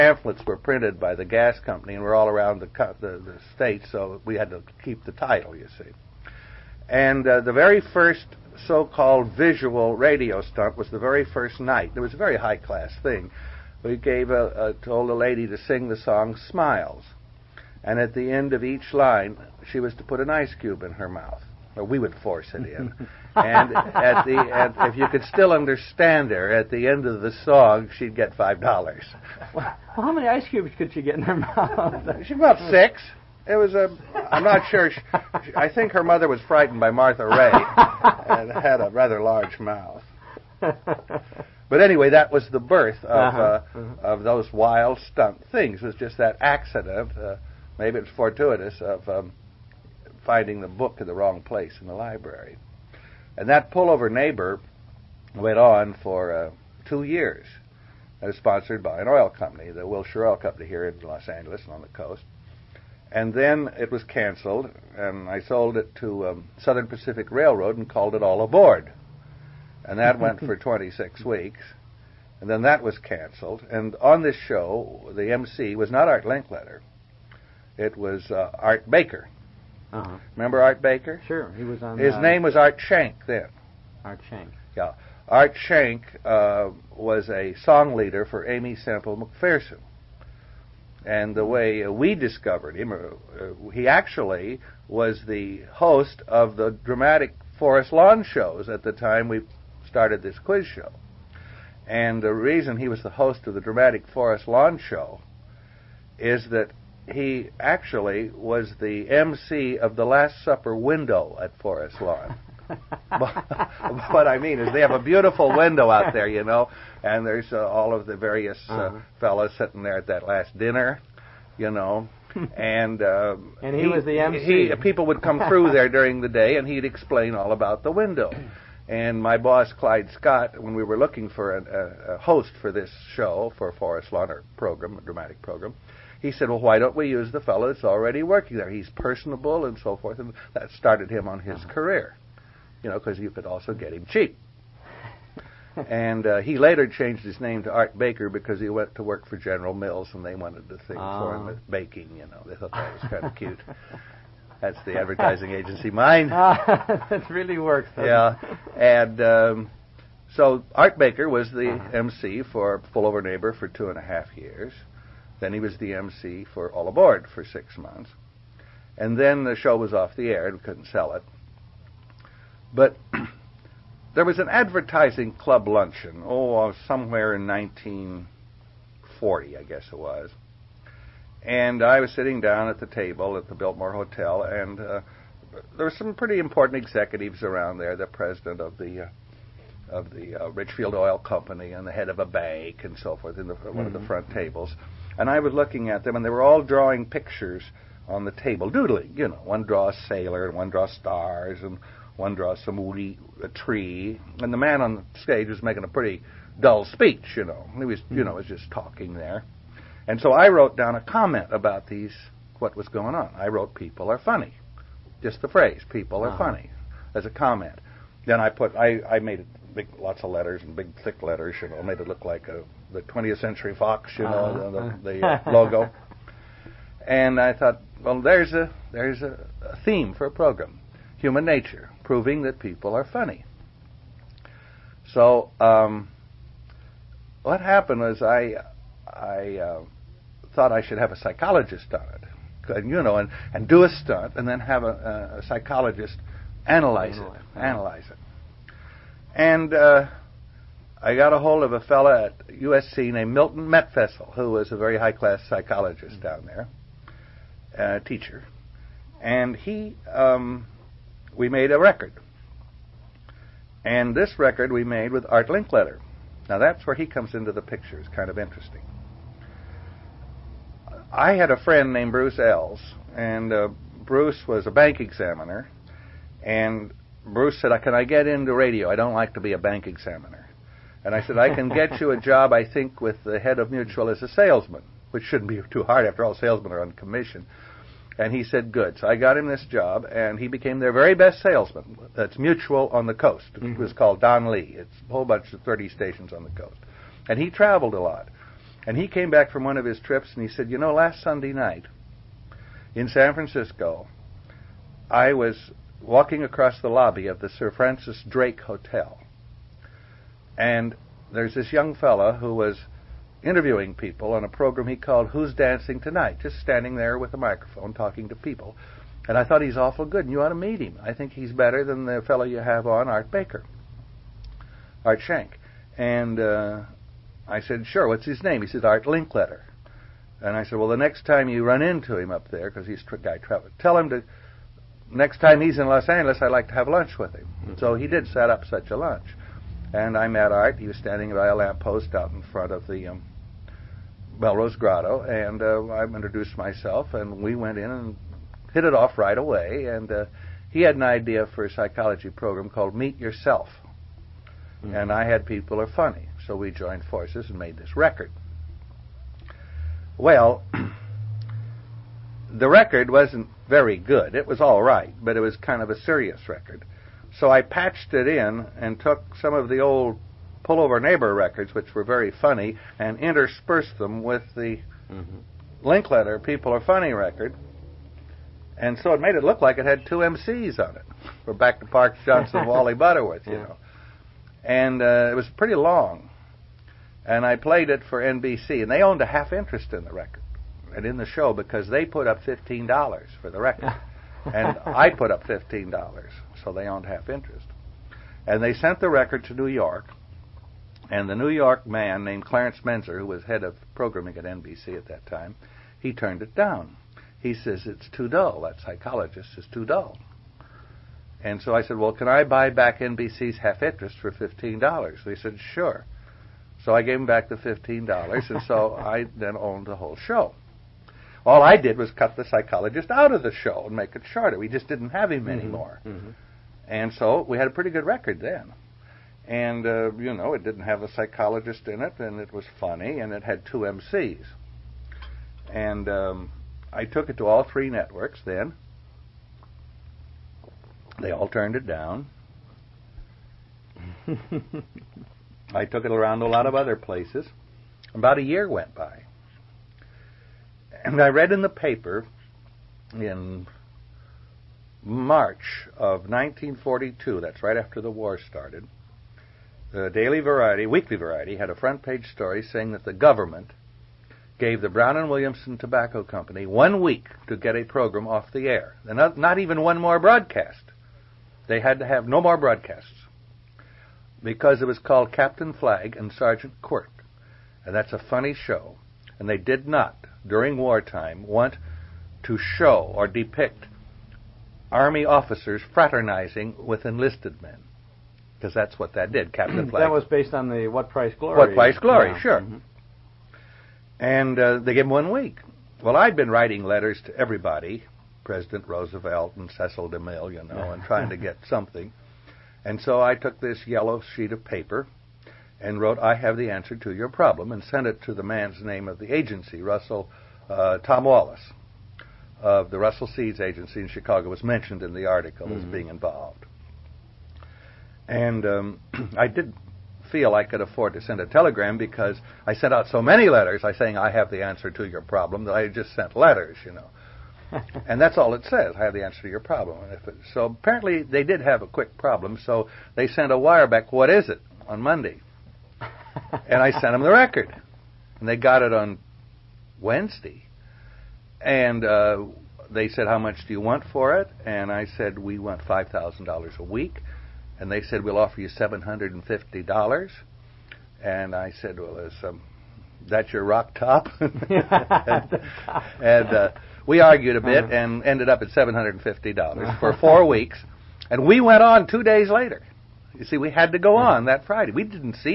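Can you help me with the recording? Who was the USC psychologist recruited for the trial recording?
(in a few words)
Milton Metfessel.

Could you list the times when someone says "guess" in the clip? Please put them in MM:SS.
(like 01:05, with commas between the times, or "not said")
02:59.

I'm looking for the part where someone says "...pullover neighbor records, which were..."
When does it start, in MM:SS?
06:10.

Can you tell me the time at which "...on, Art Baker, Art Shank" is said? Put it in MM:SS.
05:22.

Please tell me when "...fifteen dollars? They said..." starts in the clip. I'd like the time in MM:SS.
06:54.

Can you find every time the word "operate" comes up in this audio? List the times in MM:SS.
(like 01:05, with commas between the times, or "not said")
not said.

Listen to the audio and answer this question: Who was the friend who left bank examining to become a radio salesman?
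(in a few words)
Bruce Ells.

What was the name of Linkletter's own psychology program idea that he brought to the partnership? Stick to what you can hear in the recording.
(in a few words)
Meet Yourself.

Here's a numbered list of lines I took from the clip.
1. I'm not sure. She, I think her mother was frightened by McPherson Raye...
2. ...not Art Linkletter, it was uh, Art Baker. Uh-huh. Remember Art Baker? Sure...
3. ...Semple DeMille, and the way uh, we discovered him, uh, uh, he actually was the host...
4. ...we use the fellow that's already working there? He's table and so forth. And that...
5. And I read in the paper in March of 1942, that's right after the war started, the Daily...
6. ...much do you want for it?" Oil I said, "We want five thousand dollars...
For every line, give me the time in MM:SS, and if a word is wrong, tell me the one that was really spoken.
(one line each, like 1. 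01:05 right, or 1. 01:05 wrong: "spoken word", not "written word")
1. 00:34 wrong: "Martha", not "McPherson"
2. 01:15 right
3. 01:28 wrong: "McPherson", not "DeMille"
4. 02:16 wrong: "personable", not "table"
5. 07:31 right
6. 09:03 wrong: "And", not "Oil".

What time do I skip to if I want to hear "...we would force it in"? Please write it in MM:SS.
00:21.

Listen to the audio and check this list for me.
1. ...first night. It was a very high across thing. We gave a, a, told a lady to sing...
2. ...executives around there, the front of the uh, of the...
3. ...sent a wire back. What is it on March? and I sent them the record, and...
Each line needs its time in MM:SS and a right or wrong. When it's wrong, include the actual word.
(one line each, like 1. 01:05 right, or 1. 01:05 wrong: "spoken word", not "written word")
1. 00:11 wrong: "class", not "across"
2. 03:06 wrong: "president", not "front"
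3. 08:53 wrong: "Monday", not "March".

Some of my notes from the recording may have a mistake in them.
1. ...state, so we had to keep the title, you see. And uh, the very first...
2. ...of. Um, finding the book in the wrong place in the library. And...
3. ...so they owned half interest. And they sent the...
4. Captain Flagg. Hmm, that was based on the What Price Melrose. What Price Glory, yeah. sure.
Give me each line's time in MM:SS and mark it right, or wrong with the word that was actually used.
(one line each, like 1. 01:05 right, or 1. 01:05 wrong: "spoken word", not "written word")
1. 00:03 right
2. 00:48 right
3. 06:36 right
4. 08:09 wrong: "Glory", not "Melrose".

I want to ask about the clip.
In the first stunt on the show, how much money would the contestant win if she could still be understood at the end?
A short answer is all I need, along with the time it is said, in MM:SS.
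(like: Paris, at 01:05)
$5, at 00:28.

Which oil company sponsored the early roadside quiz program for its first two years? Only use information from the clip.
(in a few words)
Wilshire Oil Company.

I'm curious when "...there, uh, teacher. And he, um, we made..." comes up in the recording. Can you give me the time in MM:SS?
04:16.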